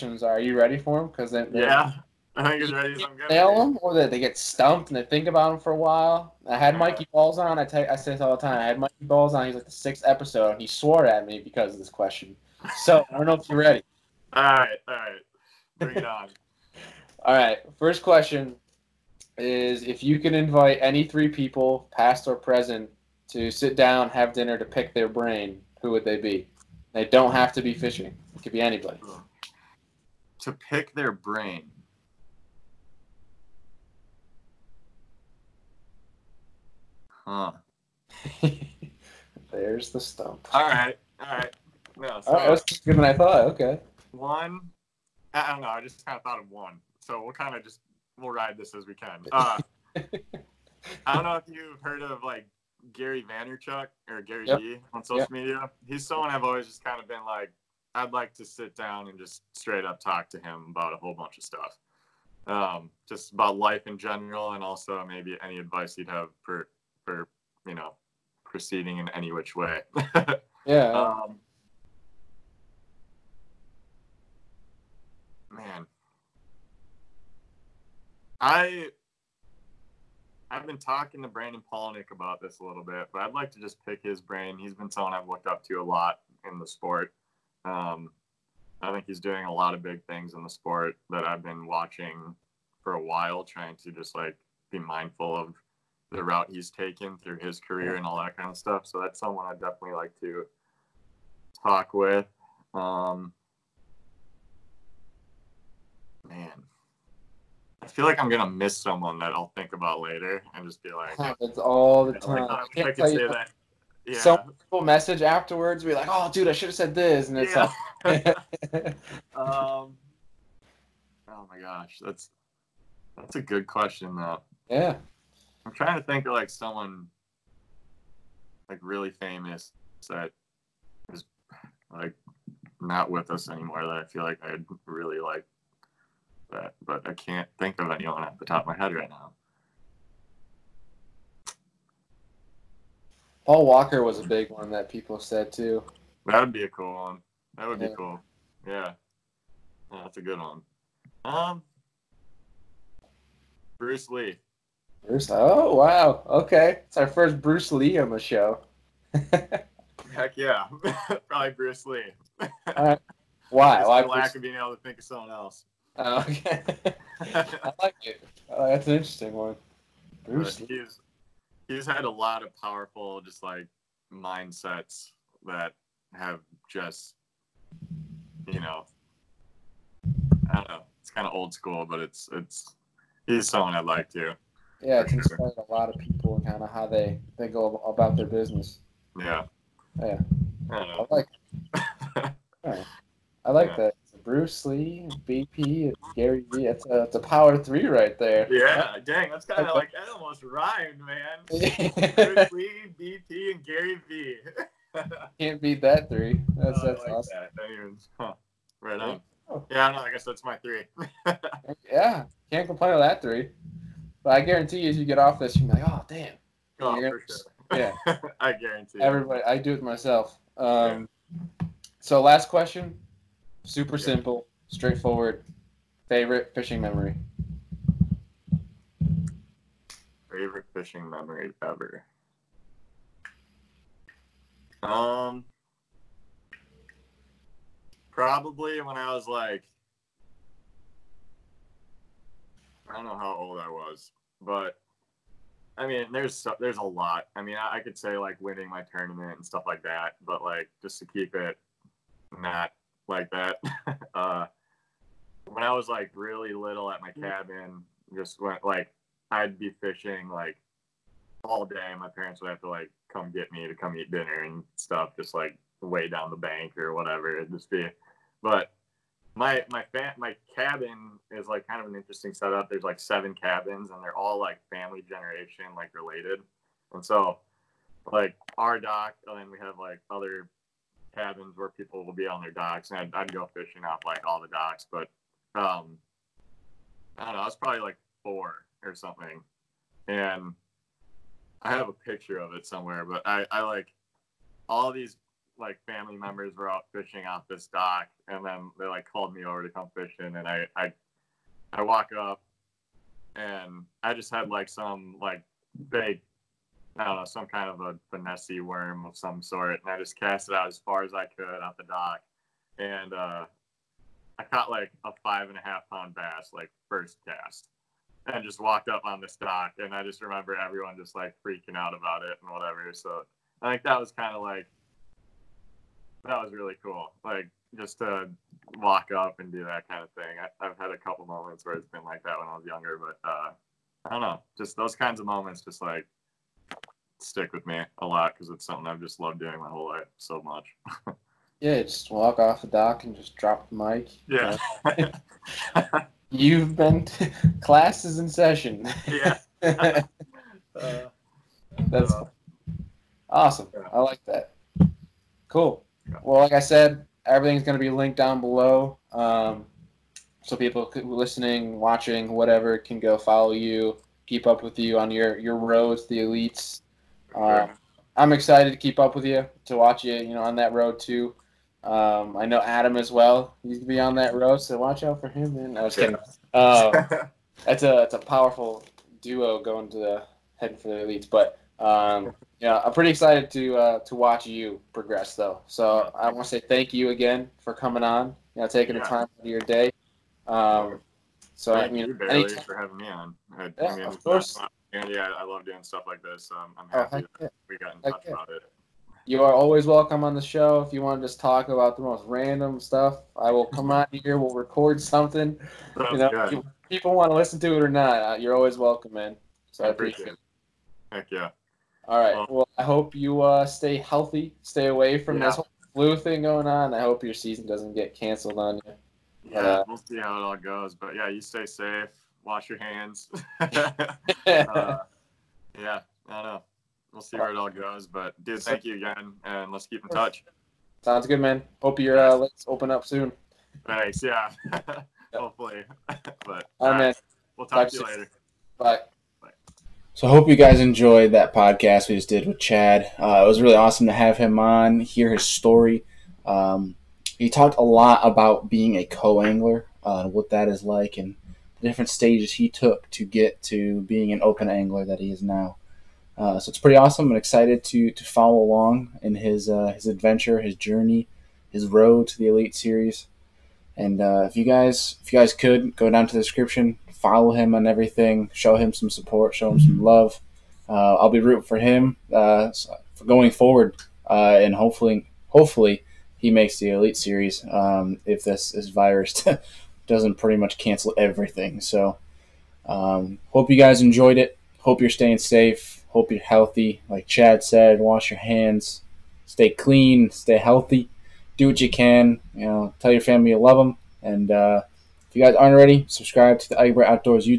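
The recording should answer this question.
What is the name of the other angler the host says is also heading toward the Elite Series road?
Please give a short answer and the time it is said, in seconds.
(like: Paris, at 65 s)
Adam, at 372 s.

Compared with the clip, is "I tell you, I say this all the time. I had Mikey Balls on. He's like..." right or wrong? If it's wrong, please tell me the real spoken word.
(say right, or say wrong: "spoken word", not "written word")
right.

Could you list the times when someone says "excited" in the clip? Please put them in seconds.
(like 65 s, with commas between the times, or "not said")
368 s, 383 s, 457 s.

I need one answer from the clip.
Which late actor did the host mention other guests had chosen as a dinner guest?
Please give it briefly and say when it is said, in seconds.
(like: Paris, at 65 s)
Paul Walker, at 143 s.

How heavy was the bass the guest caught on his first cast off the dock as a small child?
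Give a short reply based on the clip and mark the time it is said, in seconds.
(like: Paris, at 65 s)
5.5 pounds, at 315 s.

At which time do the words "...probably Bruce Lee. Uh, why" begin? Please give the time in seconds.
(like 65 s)
161 s.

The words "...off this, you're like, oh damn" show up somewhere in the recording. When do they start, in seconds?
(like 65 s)
215 s.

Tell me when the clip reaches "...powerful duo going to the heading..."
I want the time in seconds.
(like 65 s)
378 s.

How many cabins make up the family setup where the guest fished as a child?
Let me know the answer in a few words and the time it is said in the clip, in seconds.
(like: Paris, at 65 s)
7, at 272 s.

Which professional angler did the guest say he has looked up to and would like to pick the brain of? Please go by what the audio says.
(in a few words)
Brandon Palaniuk.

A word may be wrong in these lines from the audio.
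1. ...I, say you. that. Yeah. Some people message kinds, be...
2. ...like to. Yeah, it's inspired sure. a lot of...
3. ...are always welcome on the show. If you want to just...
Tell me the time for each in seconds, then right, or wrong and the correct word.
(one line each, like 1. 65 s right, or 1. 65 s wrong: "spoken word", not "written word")
1. 112 s wrong: "afterwards", not "kinds"
2. 183 s right
3. 399 s right.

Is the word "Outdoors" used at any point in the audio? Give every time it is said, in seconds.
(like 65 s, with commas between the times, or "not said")
497 s.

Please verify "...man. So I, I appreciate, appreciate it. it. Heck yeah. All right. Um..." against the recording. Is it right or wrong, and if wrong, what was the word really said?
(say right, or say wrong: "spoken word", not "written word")
right.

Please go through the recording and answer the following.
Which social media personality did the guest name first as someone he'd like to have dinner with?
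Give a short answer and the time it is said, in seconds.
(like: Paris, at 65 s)
Gary Vaynerchuk, at 52 s.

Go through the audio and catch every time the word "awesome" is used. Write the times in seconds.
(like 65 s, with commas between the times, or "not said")
207 s, 353 s, 443 s, 456 s.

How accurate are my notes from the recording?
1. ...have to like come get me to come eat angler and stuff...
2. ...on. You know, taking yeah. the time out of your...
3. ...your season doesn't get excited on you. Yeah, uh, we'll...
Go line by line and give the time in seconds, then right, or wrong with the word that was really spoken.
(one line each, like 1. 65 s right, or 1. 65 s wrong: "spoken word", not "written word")
1. 262 s wrong: "dinner", not "angler"
2. 388 s right
3. 417 s wrong: "canceled", not "excited".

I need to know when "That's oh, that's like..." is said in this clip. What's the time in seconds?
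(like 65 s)
206 s.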